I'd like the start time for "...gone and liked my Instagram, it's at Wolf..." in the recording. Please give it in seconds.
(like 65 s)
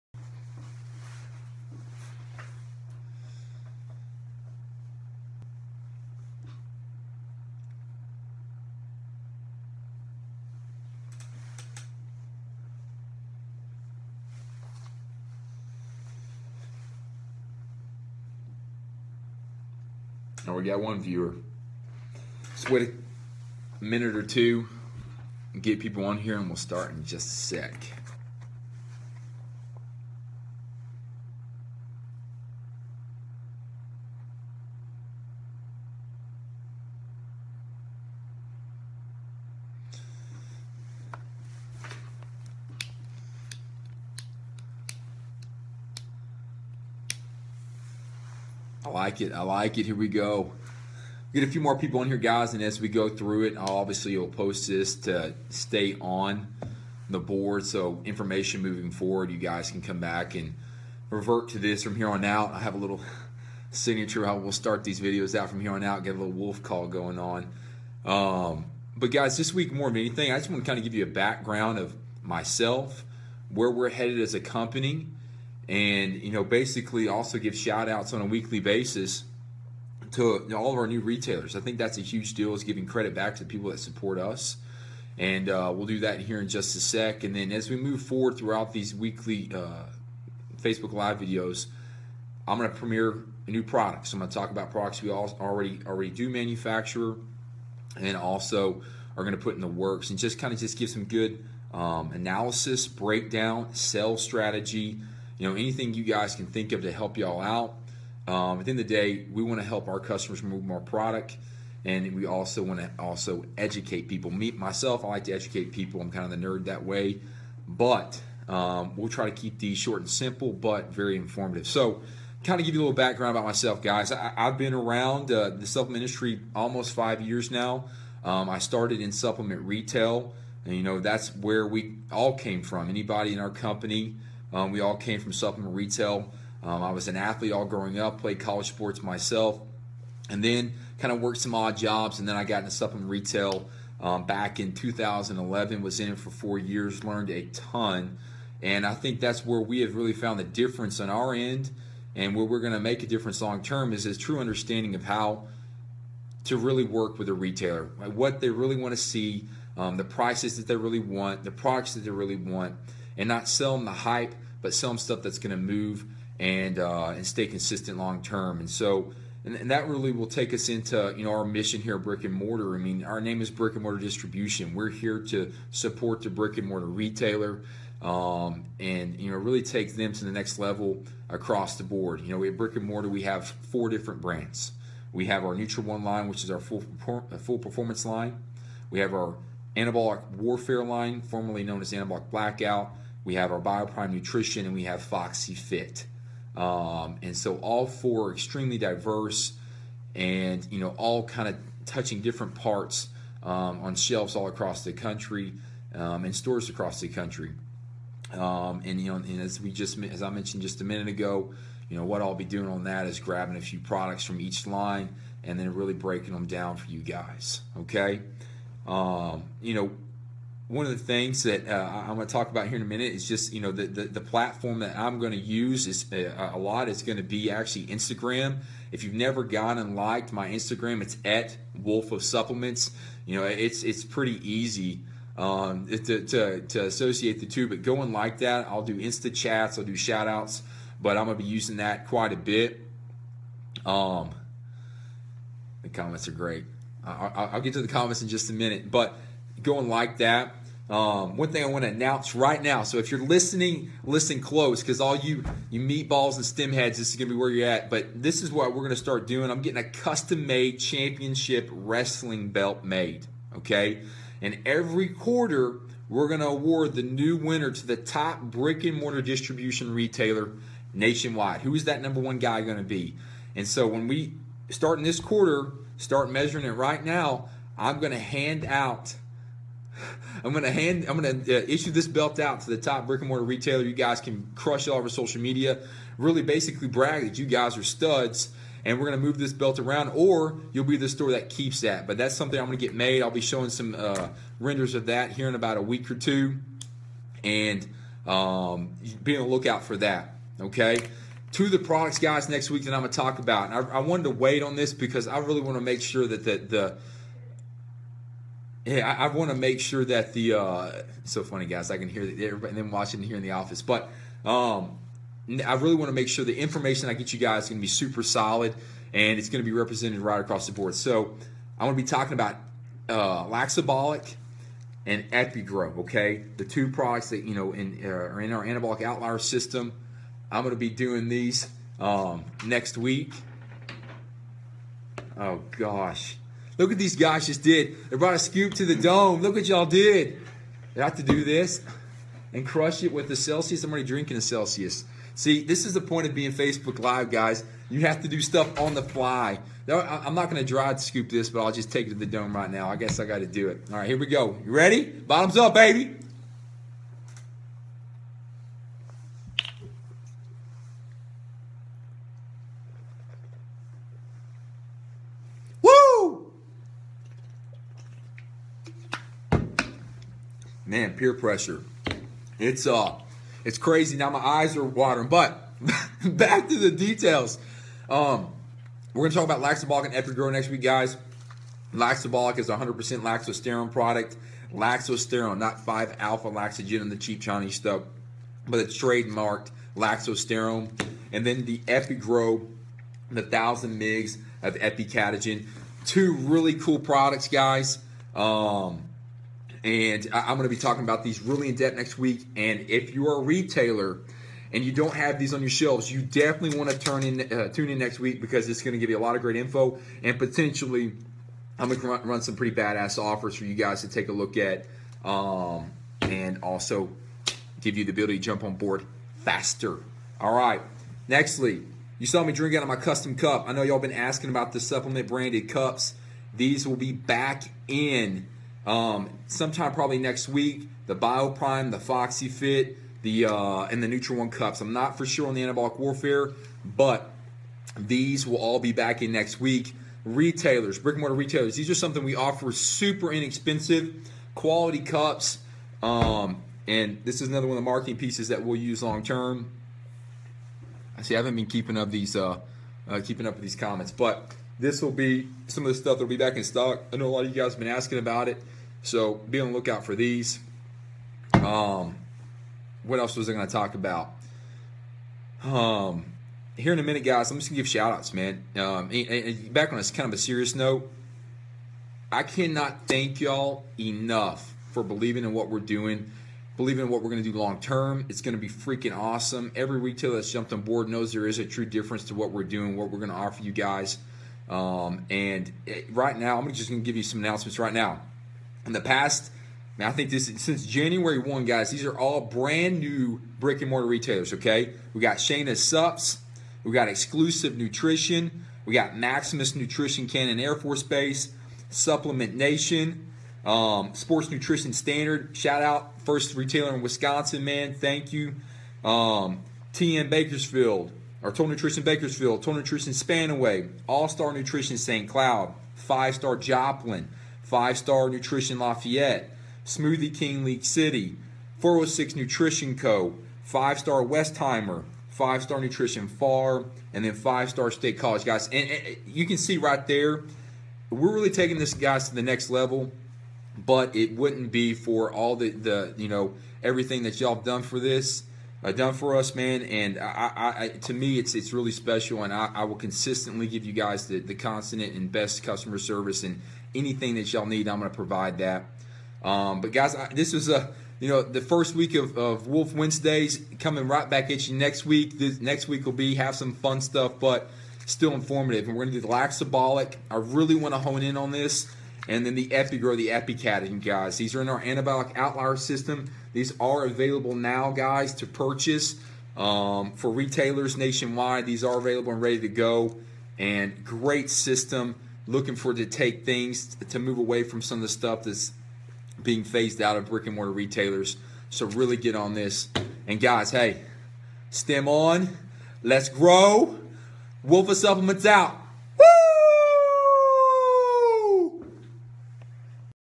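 229 s.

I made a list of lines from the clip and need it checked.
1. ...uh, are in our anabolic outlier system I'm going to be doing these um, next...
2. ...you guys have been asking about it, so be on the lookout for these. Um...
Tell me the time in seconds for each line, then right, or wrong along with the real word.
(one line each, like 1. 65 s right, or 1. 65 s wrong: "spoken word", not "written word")
1. 328 s right
2. 457 s right.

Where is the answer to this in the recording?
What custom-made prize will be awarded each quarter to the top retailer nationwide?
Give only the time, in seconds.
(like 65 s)
260 s.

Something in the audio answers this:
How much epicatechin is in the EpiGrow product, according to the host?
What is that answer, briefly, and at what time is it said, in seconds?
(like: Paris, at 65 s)
1,000 mg, at 393 s.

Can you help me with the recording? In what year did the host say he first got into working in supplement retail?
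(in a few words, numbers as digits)
2011.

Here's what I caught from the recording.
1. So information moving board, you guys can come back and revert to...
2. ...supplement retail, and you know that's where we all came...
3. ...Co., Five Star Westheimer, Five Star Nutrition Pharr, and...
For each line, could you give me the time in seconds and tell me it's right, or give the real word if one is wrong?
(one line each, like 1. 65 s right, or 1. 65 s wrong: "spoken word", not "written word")
1. 57 s wrong: "forward", not "board"
2. 129 s right
3. 522 s right.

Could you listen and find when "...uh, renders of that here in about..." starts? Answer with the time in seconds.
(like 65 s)
293 s.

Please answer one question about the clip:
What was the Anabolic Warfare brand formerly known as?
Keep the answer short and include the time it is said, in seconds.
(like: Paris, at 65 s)
Anabolic Blackout, at 191 s.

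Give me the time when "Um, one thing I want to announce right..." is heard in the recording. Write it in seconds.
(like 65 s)
250 s.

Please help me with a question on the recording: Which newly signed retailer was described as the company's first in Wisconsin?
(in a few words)
Sports Nutrition Standard.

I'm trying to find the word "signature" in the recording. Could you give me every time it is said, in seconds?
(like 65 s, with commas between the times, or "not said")
63 s.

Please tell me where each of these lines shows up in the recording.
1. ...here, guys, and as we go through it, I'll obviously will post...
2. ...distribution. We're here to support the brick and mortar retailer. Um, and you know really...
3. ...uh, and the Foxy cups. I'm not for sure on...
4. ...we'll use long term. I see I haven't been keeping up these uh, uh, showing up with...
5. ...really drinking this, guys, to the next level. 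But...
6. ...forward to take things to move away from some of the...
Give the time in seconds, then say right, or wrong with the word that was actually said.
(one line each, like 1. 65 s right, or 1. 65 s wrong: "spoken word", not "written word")
1. 52 s right
2. 173 s right
3. 433 s wrong: "NutraOne", not "Foxy"
4. 448 s wrong: "keeping", not "showing"
5. 531 s wrong: "taking", not "drinking"
6. 575 s right.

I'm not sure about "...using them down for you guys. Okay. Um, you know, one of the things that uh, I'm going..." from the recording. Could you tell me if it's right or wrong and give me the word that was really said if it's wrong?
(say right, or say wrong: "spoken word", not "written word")
wrong: "breaking", not "using".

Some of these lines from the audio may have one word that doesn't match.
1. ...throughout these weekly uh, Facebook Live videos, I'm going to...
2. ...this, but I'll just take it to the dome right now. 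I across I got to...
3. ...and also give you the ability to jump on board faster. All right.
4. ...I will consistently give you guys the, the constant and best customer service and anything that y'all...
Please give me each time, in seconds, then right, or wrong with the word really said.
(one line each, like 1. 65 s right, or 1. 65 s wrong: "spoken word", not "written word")
1. 88 s right
2. 351 s wrong: "guess", not "across"
3. 416 s right
4. 542 s right.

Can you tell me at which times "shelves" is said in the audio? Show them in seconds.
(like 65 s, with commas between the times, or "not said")
203 s, 405 s.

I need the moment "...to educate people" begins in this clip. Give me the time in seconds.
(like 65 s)
115 s.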